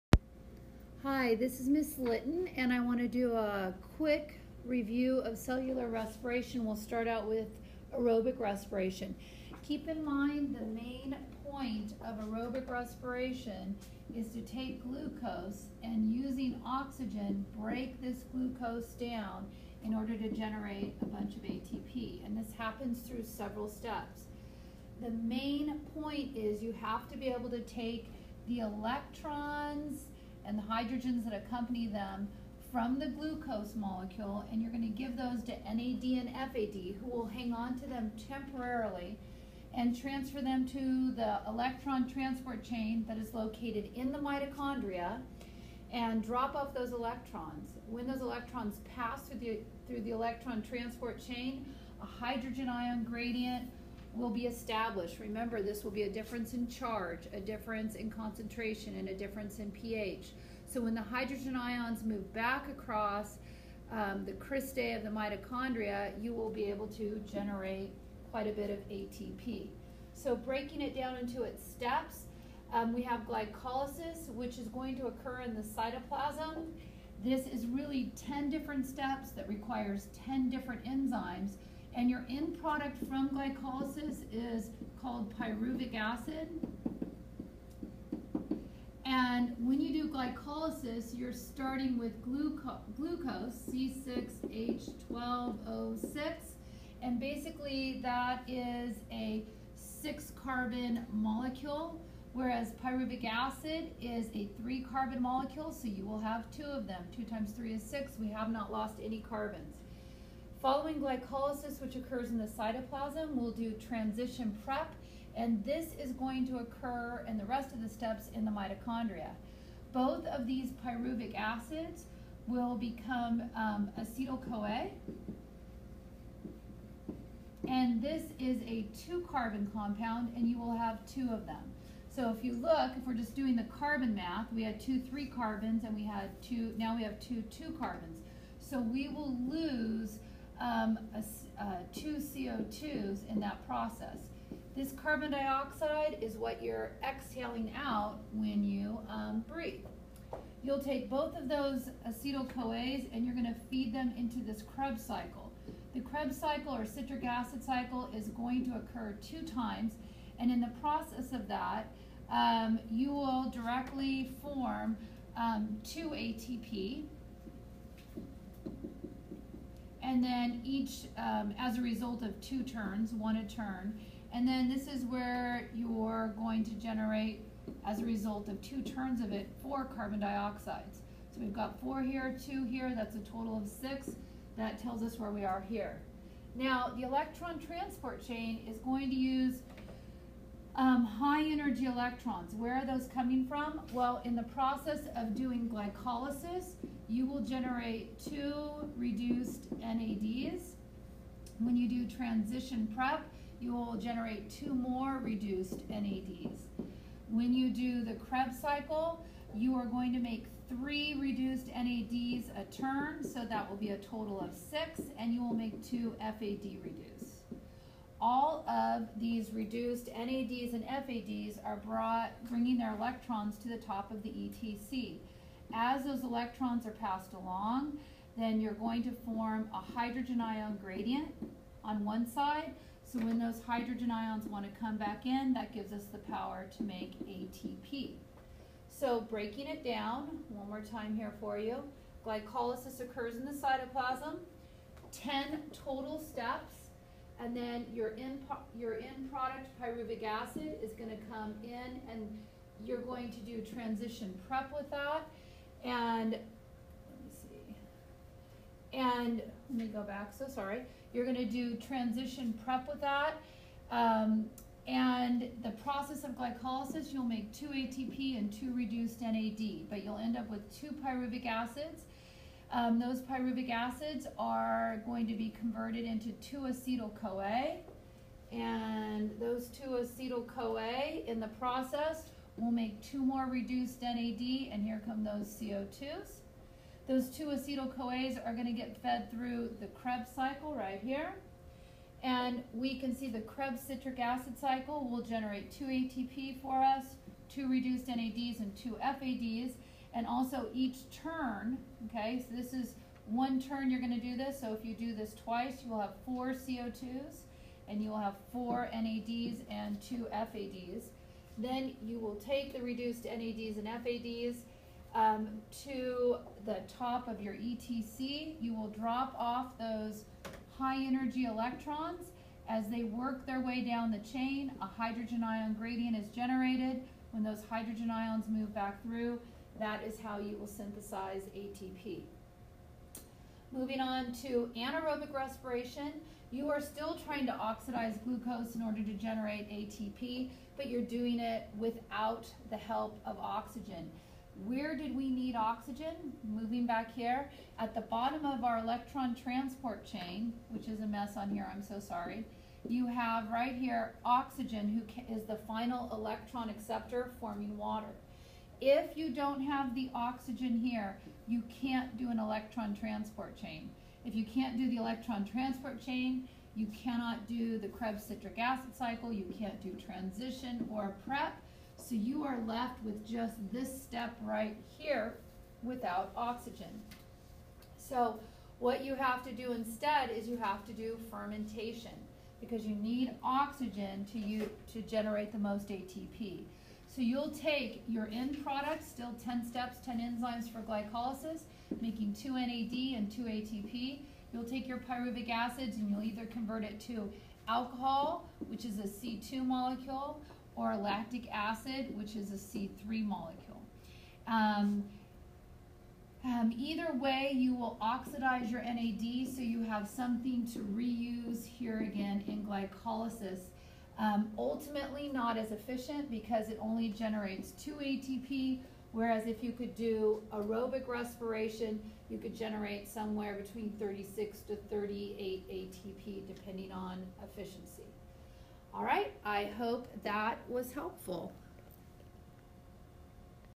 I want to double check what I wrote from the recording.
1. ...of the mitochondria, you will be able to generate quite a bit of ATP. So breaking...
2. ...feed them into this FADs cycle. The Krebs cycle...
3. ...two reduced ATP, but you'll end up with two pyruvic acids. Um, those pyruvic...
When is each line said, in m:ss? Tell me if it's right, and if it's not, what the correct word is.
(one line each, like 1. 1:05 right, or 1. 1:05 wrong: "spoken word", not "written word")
1. 1:04 right
2. 2:33 wrong: "Krebs", not "FADs"
3. 4:28 wrong: "NAD", not "ATP".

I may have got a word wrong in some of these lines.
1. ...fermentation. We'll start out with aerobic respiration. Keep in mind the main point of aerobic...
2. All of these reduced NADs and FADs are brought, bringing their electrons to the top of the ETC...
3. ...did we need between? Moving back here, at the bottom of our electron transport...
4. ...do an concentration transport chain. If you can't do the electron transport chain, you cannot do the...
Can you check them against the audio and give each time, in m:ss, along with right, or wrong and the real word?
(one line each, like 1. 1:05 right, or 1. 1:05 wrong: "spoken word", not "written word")
1. 0:05 wrong: "respiration", not "fermentation"
2. 3:38 right
3. 5:44 wrong: "oxygen", not "between"
4. 6:02 wrong: "electron", not "concentration".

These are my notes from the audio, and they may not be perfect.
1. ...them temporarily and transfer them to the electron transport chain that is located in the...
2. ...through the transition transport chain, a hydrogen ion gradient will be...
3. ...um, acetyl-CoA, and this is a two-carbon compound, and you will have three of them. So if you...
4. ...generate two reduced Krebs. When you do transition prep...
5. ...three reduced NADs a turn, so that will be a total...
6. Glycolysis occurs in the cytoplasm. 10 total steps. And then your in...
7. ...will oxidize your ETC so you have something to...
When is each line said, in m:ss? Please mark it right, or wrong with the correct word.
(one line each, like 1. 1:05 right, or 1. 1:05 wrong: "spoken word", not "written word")
1. 0:37 right
2. 0:49 wrong: "electron", not "transition"
3. 2:03 wrong: "two", not "three"
4. 3:17 wrong: "NADs", not "Krebs"
5. 3:30 right
6. 4:02 right
7. 6:47 wrong: "NAD", not "ETC".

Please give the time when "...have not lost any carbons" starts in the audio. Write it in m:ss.
1:48.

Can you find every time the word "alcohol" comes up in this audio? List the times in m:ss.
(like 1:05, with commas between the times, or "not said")
6:37.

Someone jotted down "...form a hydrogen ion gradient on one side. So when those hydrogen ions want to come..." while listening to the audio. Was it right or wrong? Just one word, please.
right.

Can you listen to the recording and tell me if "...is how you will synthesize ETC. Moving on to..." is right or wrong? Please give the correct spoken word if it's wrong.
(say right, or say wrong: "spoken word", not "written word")
wrong: "ATP", not "ETC".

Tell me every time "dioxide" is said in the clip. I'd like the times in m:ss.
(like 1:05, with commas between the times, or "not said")
2:25, 3:00.